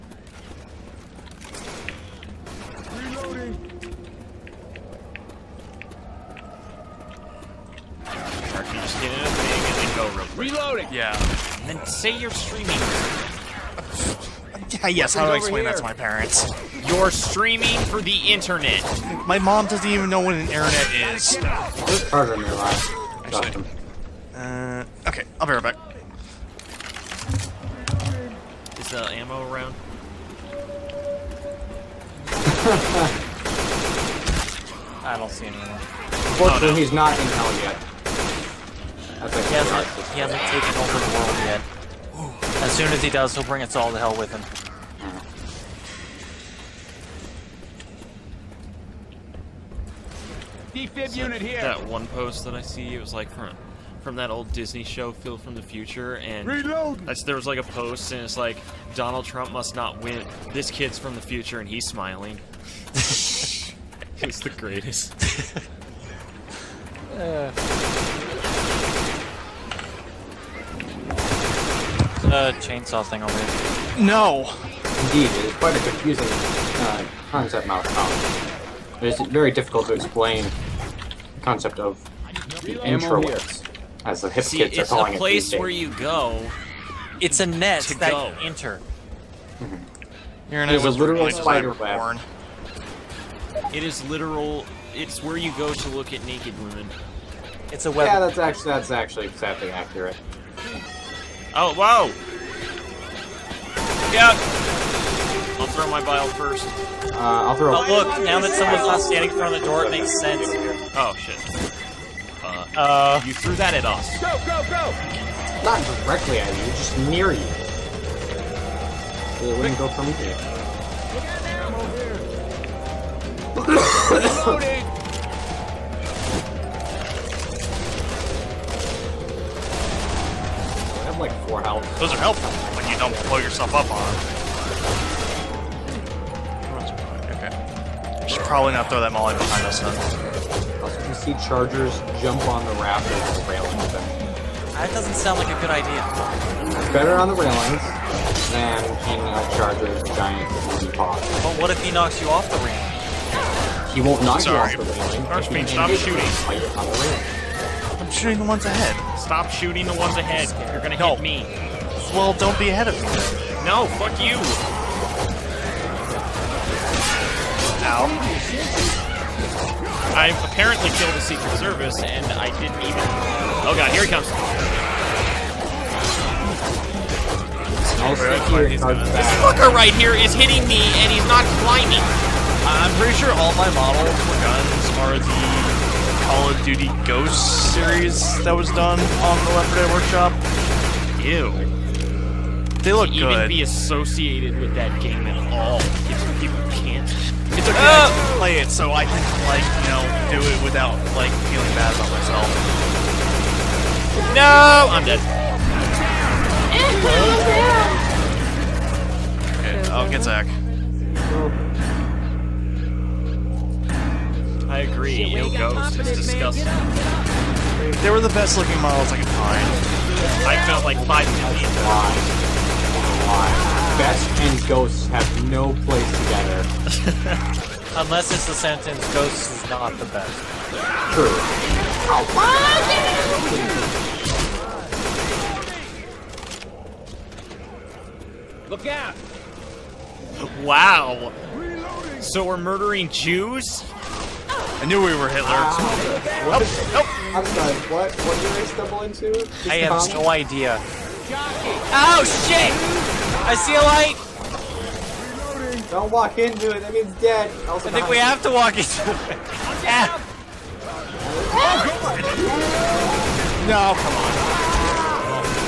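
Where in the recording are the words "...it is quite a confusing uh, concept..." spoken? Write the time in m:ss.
1:15.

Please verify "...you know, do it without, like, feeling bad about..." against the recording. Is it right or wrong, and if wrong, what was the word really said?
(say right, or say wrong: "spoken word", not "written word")
right.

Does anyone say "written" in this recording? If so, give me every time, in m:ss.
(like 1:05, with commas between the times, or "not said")
not said.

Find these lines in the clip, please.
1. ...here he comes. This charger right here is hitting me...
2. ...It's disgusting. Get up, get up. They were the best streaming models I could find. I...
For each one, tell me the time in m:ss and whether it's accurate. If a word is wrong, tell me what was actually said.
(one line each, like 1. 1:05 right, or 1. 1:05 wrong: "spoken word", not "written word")
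1. 2:53 wrong: "fucker", not "charger"
2. 3:35 wrong: "looking", not "streaming".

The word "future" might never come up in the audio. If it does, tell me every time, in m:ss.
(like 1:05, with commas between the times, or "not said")
0:55, 1:01.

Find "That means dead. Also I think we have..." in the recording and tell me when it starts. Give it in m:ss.
4:16.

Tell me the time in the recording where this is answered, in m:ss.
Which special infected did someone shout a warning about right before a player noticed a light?
4:11.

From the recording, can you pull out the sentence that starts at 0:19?
My mom doesn't even know what an internet is.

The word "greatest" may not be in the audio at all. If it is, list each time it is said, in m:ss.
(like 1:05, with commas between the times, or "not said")
1:04.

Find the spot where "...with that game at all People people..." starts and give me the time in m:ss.
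3:14.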